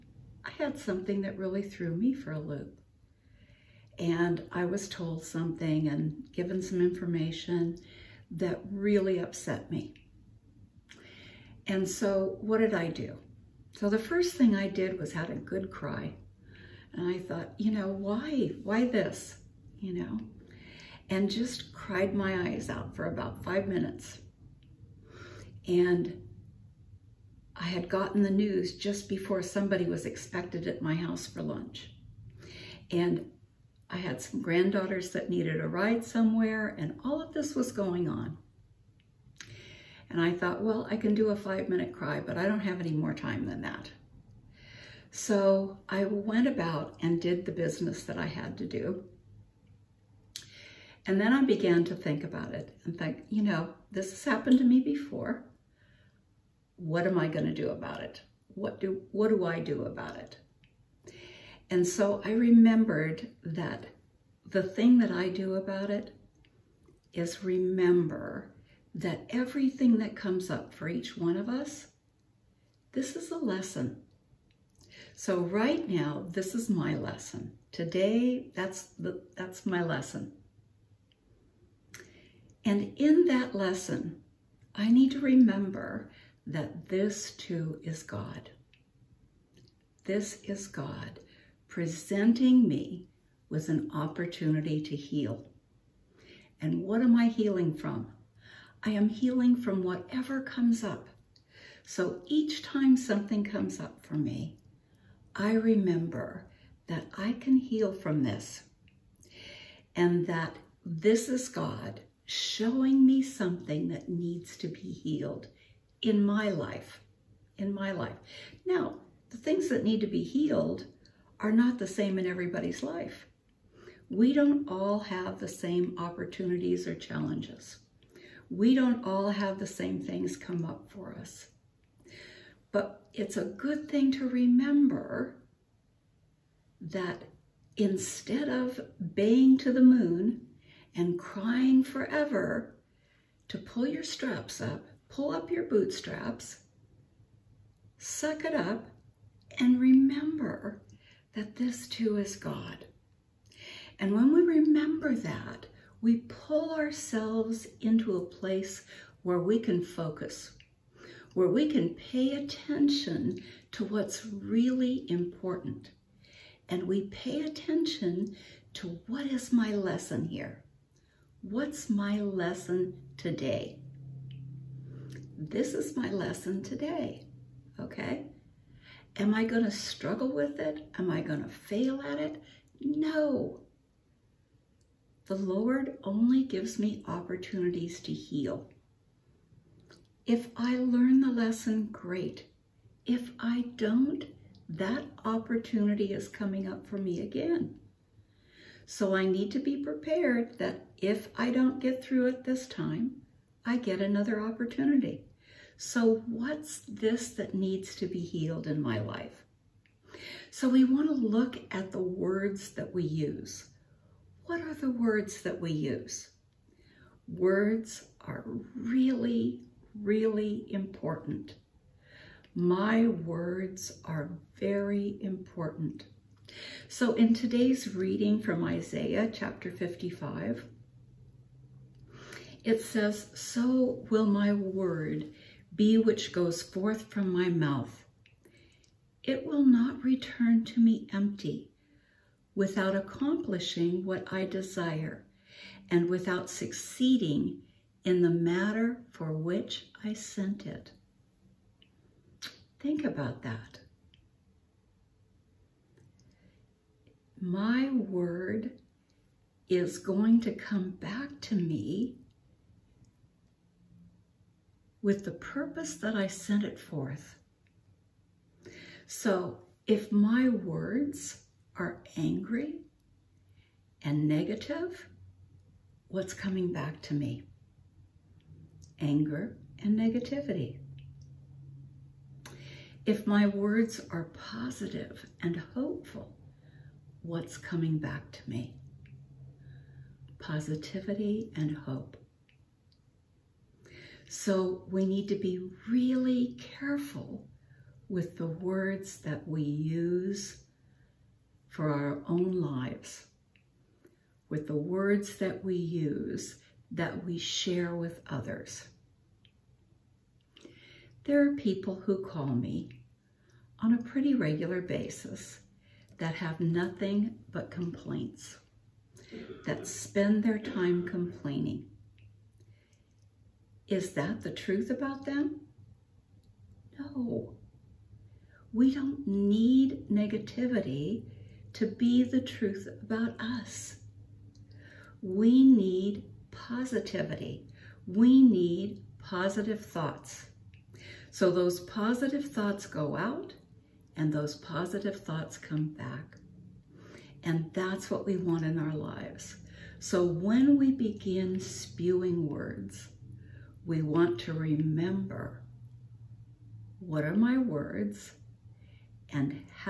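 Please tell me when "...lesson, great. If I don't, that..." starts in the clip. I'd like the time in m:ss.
3:11.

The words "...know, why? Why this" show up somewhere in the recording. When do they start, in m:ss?
0:17.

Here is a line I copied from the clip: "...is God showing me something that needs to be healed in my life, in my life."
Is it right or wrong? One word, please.
right.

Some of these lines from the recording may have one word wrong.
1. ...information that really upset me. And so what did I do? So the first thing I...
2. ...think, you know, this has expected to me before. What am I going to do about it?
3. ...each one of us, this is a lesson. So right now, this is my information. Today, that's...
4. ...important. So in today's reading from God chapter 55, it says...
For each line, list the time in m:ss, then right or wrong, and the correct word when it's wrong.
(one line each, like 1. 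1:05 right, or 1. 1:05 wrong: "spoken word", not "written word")
1. 0:06 right
2. 0:52 wrong: "happened", not "expected"
3. 1:10 wrong: "lesson", not "information"
4. 3:45 wrong: "Isaiah", not "God".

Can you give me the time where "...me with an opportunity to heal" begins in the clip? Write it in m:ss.
1:32.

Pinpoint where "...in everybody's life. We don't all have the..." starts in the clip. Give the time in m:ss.
2:02.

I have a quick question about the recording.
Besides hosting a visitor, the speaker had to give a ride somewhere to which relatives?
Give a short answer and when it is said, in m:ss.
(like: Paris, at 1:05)
Granddaughters, at 0:34.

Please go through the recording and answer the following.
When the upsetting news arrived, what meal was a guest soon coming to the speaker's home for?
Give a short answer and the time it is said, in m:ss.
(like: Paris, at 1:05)
Lunch, at 0:31.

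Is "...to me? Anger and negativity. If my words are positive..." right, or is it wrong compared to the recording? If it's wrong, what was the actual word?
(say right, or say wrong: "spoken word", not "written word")
right.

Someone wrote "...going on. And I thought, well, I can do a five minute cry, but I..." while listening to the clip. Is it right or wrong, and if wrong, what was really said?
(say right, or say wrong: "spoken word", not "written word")
right.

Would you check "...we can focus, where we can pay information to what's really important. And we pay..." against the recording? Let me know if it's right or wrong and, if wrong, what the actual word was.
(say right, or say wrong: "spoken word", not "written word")
wrong: "attention", not "information".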